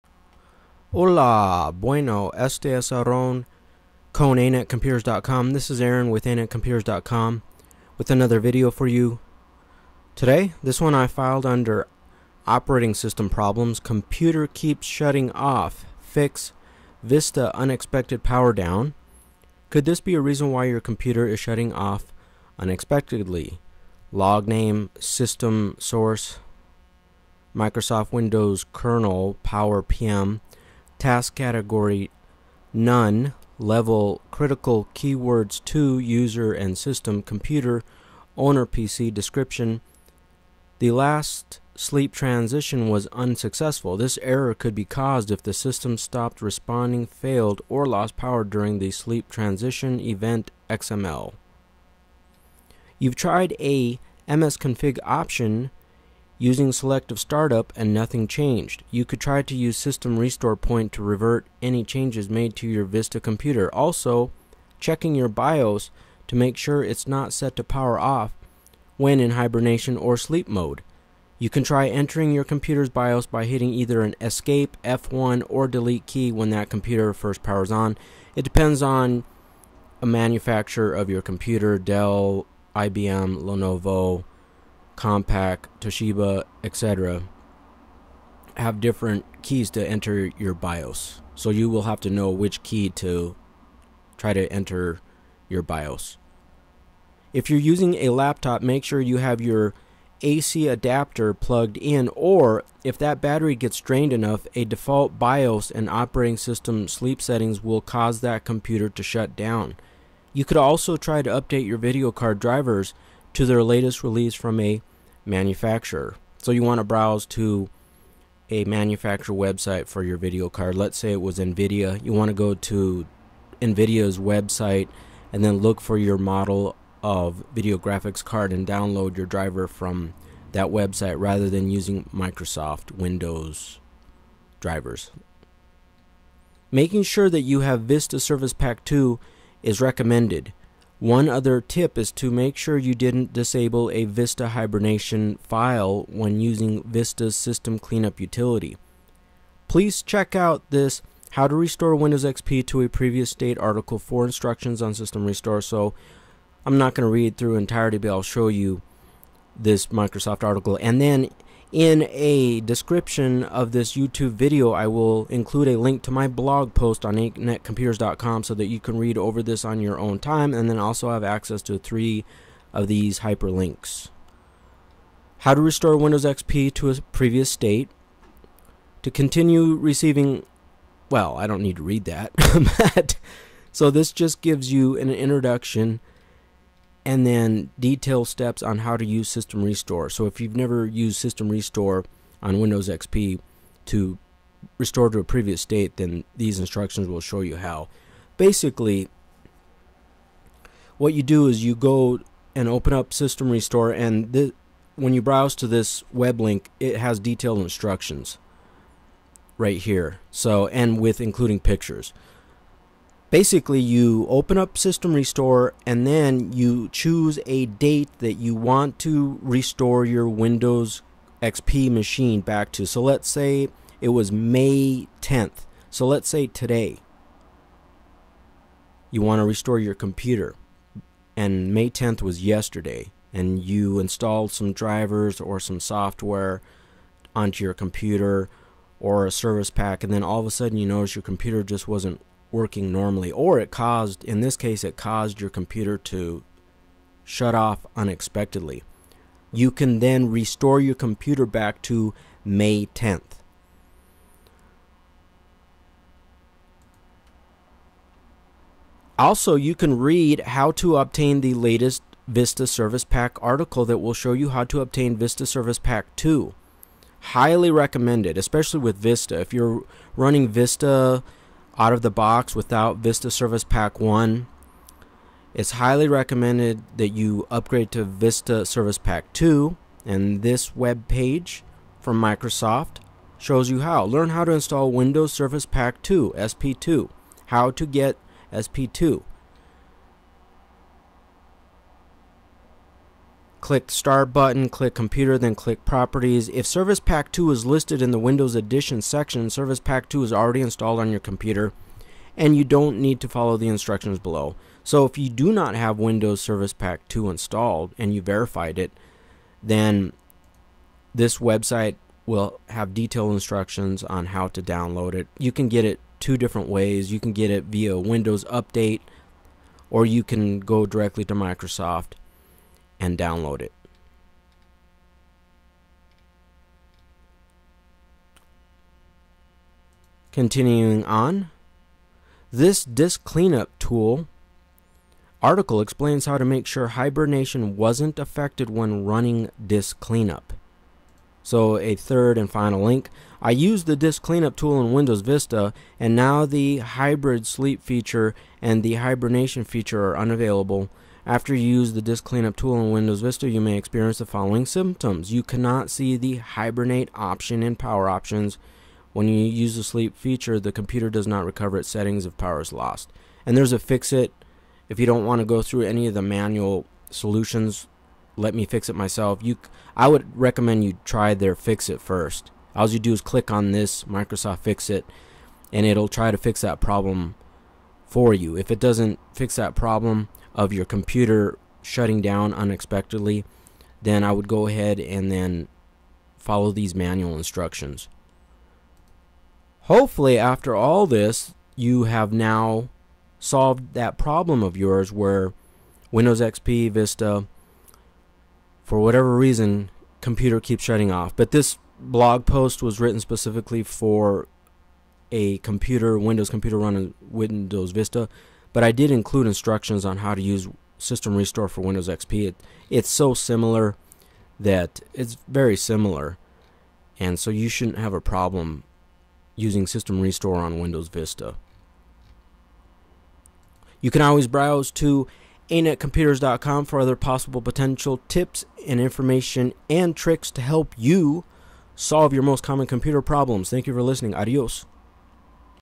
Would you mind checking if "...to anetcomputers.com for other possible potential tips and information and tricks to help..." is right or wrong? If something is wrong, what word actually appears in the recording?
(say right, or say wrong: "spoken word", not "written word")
right.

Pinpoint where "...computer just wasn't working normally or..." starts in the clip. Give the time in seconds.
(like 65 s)
241 s.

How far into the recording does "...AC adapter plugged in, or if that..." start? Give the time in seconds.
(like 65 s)
100 s.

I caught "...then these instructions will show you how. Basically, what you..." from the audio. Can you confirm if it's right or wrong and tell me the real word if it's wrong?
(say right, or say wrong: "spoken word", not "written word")
right.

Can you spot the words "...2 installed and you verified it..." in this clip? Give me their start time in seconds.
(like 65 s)
307 s.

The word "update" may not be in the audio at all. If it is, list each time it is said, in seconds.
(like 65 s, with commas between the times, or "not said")
111 s, 318 s.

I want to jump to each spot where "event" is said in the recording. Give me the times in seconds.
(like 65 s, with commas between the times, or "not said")
49 s.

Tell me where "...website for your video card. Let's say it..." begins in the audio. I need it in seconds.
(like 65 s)
119 s.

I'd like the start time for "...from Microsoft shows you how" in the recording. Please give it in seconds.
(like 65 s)
281 s.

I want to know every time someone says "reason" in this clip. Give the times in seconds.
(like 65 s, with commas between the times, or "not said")
20 s, 399 s.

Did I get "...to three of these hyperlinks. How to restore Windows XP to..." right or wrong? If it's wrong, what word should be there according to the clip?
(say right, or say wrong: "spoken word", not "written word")
right.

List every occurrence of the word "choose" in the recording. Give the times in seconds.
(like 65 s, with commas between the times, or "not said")
216 s.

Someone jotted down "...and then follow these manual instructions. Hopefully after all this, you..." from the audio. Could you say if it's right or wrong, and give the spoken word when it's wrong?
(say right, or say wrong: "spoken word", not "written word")
right.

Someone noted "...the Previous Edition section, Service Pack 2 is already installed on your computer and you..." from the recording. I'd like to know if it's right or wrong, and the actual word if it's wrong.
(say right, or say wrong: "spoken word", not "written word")
wrong: "Windows", not "Previous".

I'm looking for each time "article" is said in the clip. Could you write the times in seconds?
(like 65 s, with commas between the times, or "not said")
153 s, 160 s, 263 s, 335 s.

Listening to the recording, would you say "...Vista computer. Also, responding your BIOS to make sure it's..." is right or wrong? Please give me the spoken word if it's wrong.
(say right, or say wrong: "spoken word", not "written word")
wrong: "checking", not "responding".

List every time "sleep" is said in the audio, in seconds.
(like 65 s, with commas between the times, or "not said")
41 s, 48 s, 70 s, 106 s, 347 s, 359 s.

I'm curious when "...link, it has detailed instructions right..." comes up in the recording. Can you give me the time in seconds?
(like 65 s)
206 s.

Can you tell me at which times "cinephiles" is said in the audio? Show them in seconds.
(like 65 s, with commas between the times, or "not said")
not said.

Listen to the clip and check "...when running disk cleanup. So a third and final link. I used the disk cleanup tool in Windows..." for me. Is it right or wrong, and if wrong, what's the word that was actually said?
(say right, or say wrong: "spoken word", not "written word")
right.